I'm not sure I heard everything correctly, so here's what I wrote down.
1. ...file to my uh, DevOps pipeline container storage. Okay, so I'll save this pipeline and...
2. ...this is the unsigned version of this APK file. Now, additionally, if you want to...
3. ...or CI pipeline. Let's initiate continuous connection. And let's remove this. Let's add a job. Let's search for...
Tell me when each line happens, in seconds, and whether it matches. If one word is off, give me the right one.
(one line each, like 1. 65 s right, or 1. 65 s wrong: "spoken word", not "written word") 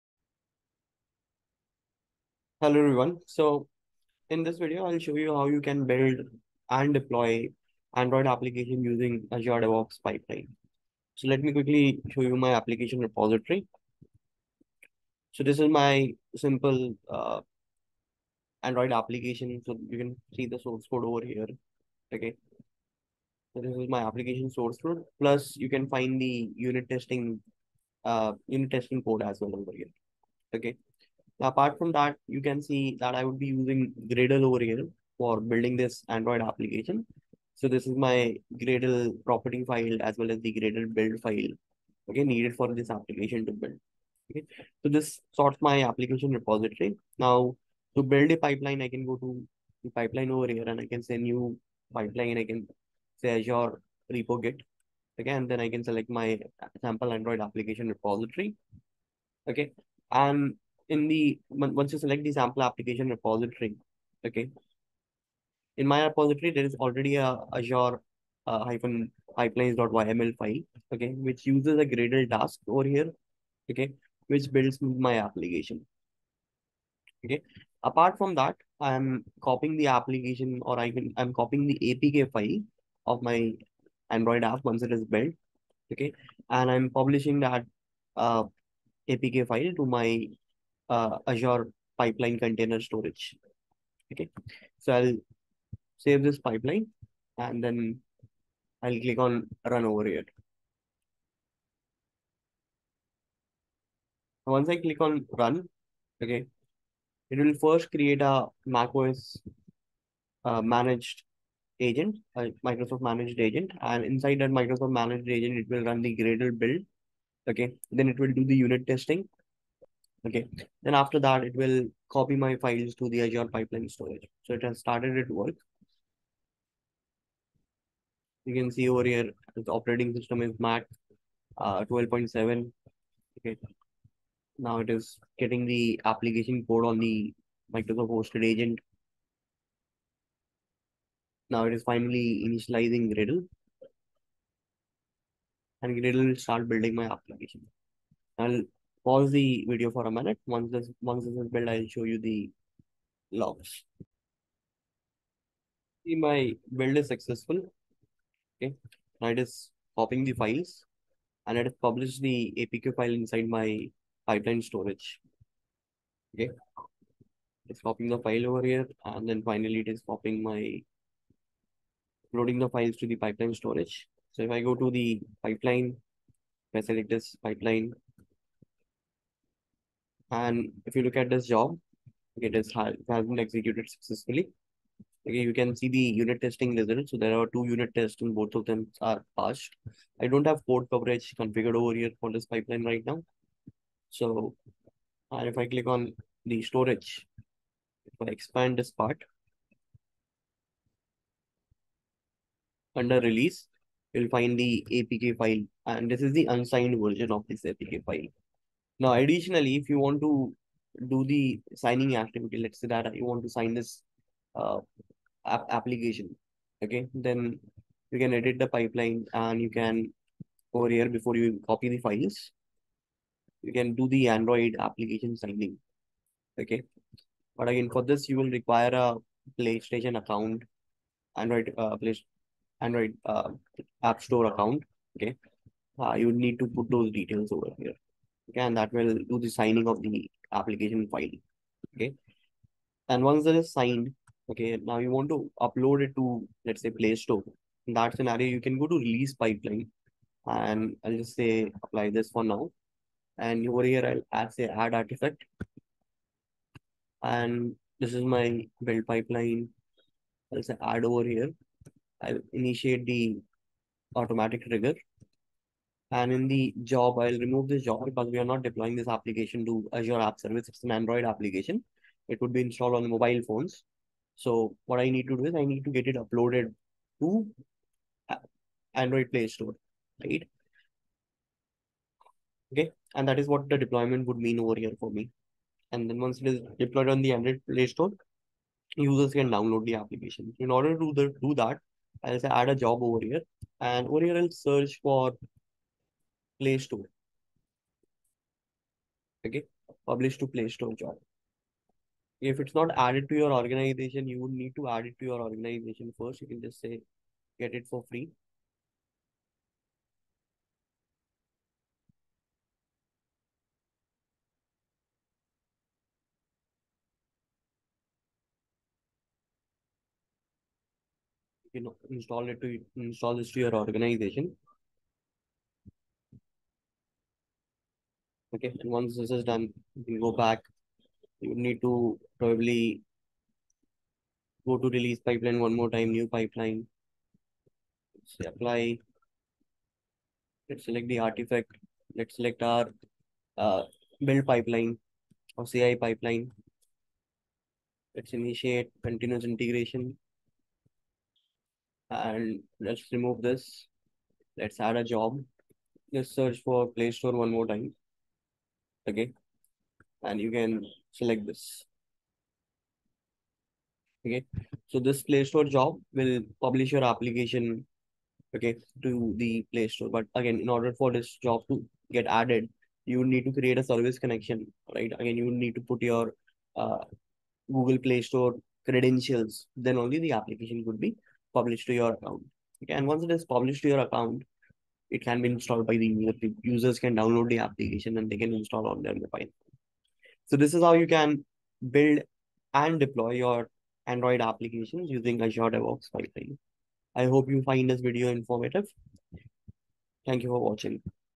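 1. 89 s wrong: "Azure", not "DevOps"
2. 206 s right
3. 345 s wrong: "integration", not "connection".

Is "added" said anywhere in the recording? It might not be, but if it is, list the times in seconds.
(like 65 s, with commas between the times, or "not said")
302 s, 372 s.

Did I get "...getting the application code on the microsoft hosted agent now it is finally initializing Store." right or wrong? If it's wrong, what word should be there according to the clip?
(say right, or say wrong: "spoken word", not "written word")
wrong: "Gradle", not "Store".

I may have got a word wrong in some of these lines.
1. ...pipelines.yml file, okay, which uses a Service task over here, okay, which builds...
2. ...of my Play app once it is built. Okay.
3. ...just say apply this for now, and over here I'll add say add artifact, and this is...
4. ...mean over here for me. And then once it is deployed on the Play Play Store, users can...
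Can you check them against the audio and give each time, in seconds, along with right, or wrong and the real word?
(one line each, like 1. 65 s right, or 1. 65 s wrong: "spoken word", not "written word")
1. 69 s wrong: "Gradle", not "Service"
2. 83 s wrong: "Android", not "Play"
3. 251 s right
4. 284 s wrong: "Android", not "Play".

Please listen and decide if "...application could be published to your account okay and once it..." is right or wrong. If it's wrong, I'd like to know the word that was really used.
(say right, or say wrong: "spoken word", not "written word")
right.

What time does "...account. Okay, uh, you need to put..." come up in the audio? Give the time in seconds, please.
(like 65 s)
234 s.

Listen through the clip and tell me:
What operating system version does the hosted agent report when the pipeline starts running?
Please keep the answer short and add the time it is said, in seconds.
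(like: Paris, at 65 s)
macOS 12.7, at 130 s.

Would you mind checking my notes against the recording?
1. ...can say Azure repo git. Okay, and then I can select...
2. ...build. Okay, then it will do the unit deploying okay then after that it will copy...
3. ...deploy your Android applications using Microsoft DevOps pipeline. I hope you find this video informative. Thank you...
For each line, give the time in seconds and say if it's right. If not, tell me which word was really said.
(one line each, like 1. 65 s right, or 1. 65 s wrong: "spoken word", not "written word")
1. 52 s right
2. 116 s wrong: "testing", not "deploying"
3. 392 s wrong: "Azure", not "Microsoft".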